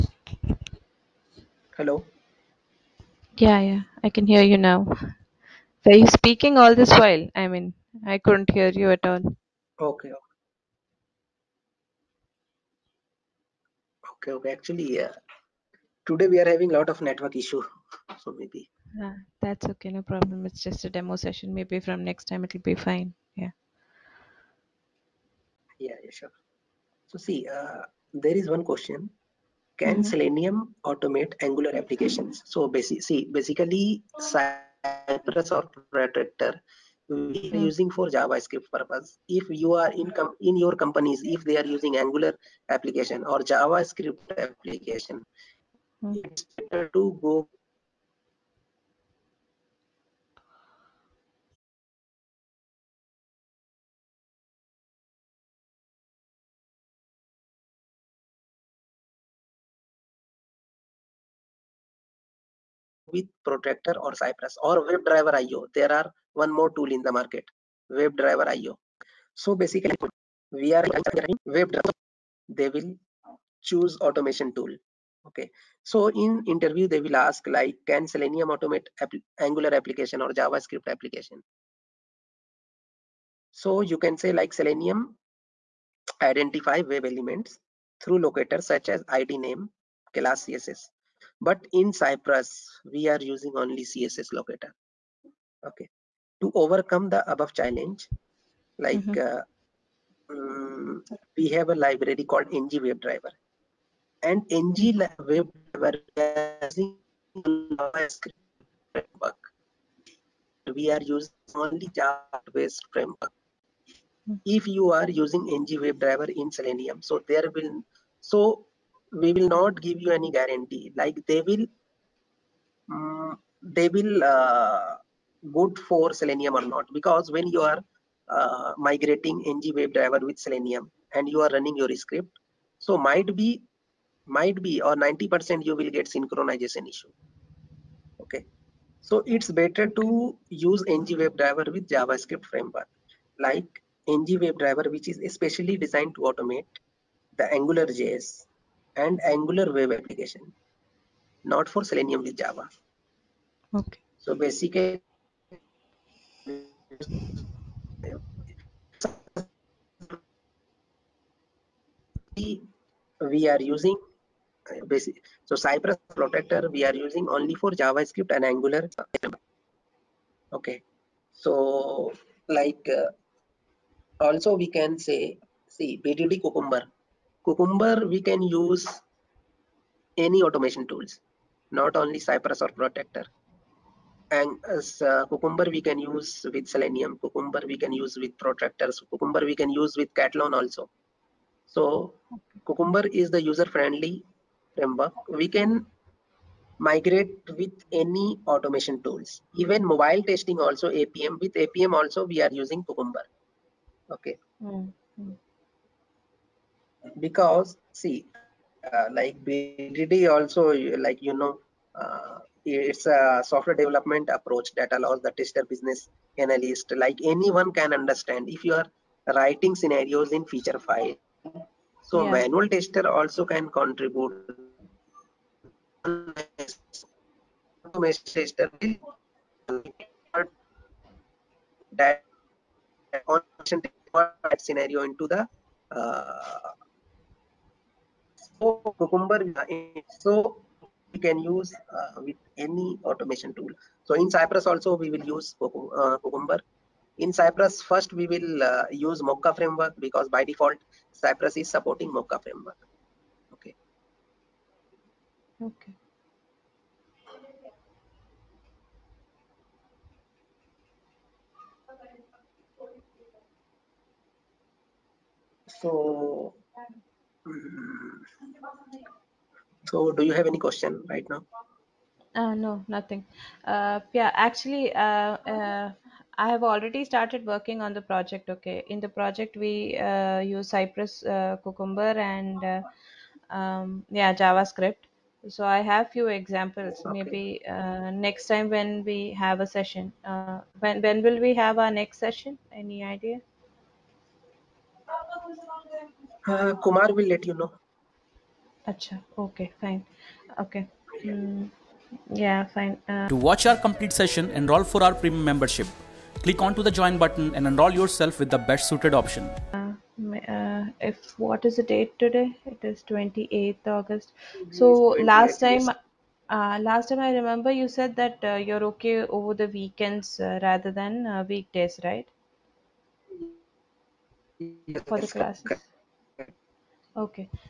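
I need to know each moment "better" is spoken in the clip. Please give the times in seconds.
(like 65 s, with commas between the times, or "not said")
46 s, 139 s.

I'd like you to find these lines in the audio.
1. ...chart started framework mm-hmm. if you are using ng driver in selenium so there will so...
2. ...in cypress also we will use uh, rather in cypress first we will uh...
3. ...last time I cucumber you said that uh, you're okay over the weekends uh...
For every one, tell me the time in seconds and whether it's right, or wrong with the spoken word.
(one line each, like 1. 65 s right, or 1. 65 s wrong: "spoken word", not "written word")
1. 111 s wrong: "based", not "started"
2. 244 s wrong: "cucumber", not "rather"
3. 316 s wrong: "remember", not "cucumber".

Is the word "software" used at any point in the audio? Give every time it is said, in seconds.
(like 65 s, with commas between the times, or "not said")
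213 s.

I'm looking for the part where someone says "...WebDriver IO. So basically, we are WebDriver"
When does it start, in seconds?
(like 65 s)
67 s.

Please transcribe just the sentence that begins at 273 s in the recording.
Uh, yeah, actually, uh, uh I have already started working on the project.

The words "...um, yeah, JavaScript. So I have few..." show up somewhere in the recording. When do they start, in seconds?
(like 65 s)
283 s.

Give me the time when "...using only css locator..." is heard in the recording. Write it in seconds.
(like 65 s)
93 s.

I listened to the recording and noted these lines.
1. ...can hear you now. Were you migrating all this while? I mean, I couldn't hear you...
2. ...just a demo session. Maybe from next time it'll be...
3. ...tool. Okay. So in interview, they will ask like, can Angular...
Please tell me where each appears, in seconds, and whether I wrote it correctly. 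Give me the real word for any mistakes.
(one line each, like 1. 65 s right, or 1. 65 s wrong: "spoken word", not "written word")
1. 4 s wrong: "speaking", not "migrating"
2. 20 s right
3. 74 s wrong: "Selenium", not "Angular".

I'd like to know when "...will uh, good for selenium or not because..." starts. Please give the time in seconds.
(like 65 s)
123 s.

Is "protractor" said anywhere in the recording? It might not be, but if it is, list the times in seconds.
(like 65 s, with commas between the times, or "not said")
35 s, 63 s, 166 s, 182 s, 188 s.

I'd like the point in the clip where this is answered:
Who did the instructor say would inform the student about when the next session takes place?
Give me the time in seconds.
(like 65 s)
296 s.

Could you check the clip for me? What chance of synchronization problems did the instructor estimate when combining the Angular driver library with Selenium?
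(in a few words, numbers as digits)
90%.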